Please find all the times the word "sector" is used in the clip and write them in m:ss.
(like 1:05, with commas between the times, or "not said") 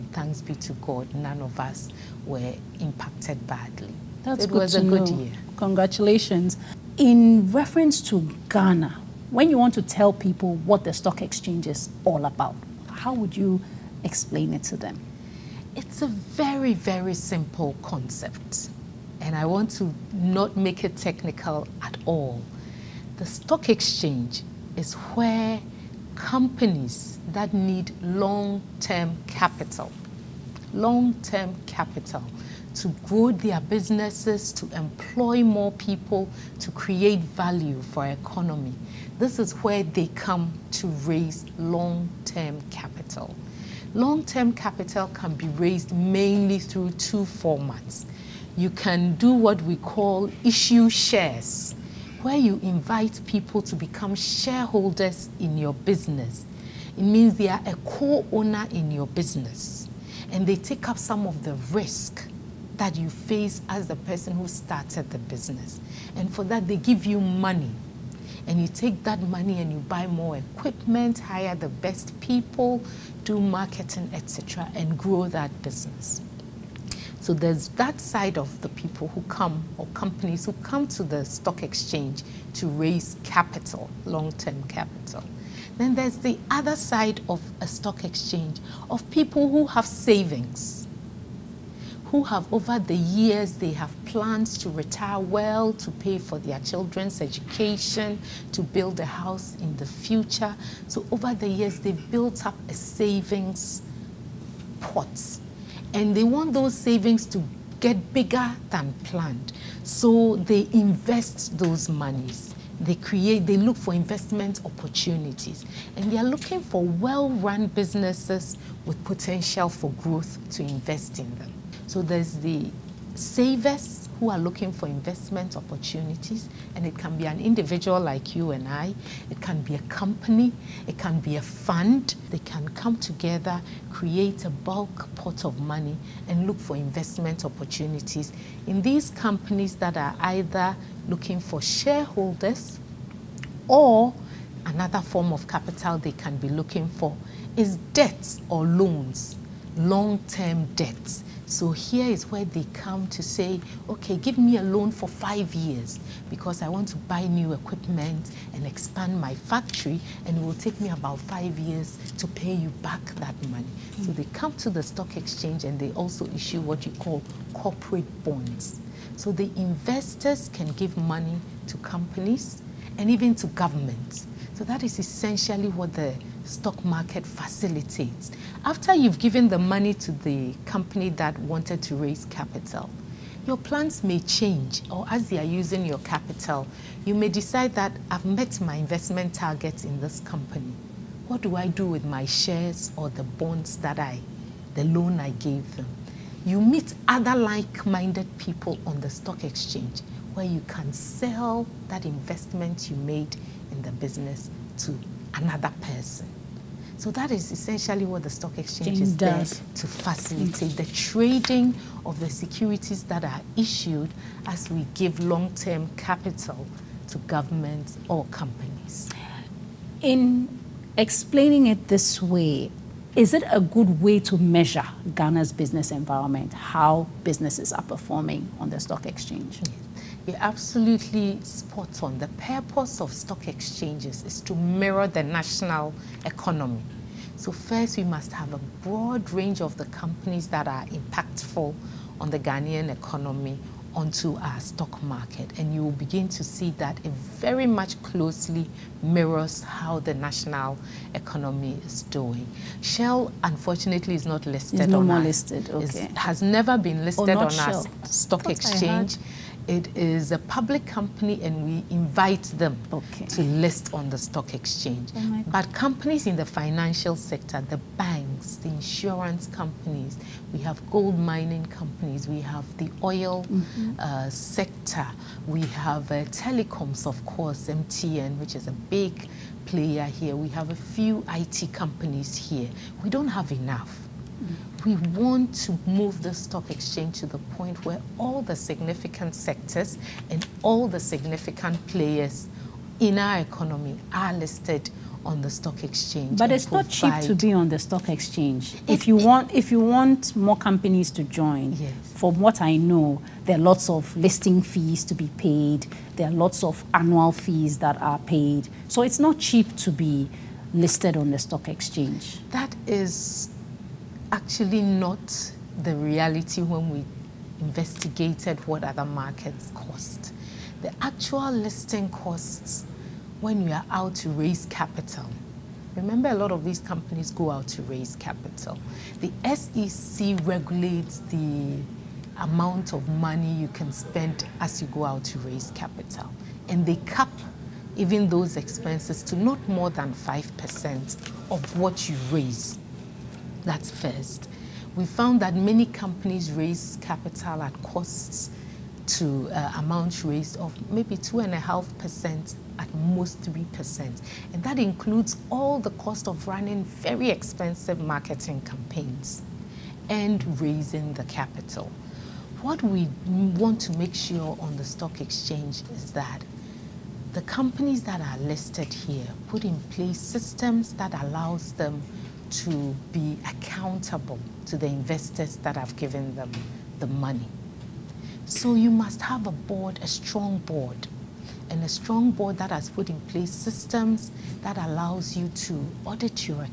4:27, 4:34, 4:49.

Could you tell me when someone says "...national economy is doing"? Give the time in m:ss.
4:10.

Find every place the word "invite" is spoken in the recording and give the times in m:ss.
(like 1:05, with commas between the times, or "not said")
0:52, 4:21.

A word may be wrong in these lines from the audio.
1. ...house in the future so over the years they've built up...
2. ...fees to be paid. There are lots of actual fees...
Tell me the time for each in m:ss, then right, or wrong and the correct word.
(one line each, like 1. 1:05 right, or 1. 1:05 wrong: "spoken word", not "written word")
1. 1:39 right
2. 5:04 wrong: "annual", not "actual".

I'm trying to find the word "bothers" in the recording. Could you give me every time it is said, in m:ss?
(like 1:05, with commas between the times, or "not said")
not said.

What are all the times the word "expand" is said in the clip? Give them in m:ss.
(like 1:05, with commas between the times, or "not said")
2:38.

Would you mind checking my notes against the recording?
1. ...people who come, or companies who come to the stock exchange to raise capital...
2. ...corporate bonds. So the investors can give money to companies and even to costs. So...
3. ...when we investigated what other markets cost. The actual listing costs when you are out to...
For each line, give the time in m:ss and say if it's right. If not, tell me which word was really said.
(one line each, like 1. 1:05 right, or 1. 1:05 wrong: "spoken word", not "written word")
1. 1:18 right
2. 2:47 wrong: "governments", not "costs"
3. 5:16 right.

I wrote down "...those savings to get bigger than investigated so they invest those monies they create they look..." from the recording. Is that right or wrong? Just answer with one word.
wrong.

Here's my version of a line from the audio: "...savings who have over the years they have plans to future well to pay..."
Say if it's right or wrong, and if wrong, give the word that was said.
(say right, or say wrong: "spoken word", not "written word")
wrong: "retire", not "future".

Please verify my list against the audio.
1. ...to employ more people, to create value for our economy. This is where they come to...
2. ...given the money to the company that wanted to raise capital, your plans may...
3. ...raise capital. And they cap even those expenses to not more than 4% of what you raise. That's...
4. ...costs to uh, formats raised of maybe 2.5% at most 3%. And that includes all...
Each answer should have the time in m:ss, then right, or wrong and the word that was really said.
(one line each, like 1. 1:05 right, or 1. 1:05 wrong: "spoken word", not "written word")
1. 0:34 right
2. 2:59 right
3. 5:35 wrong: "5", not "4"
4. 5:47 wrong: "amounts", not "formats".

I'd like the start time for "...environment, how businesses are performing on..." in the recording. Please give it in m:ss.
3:45.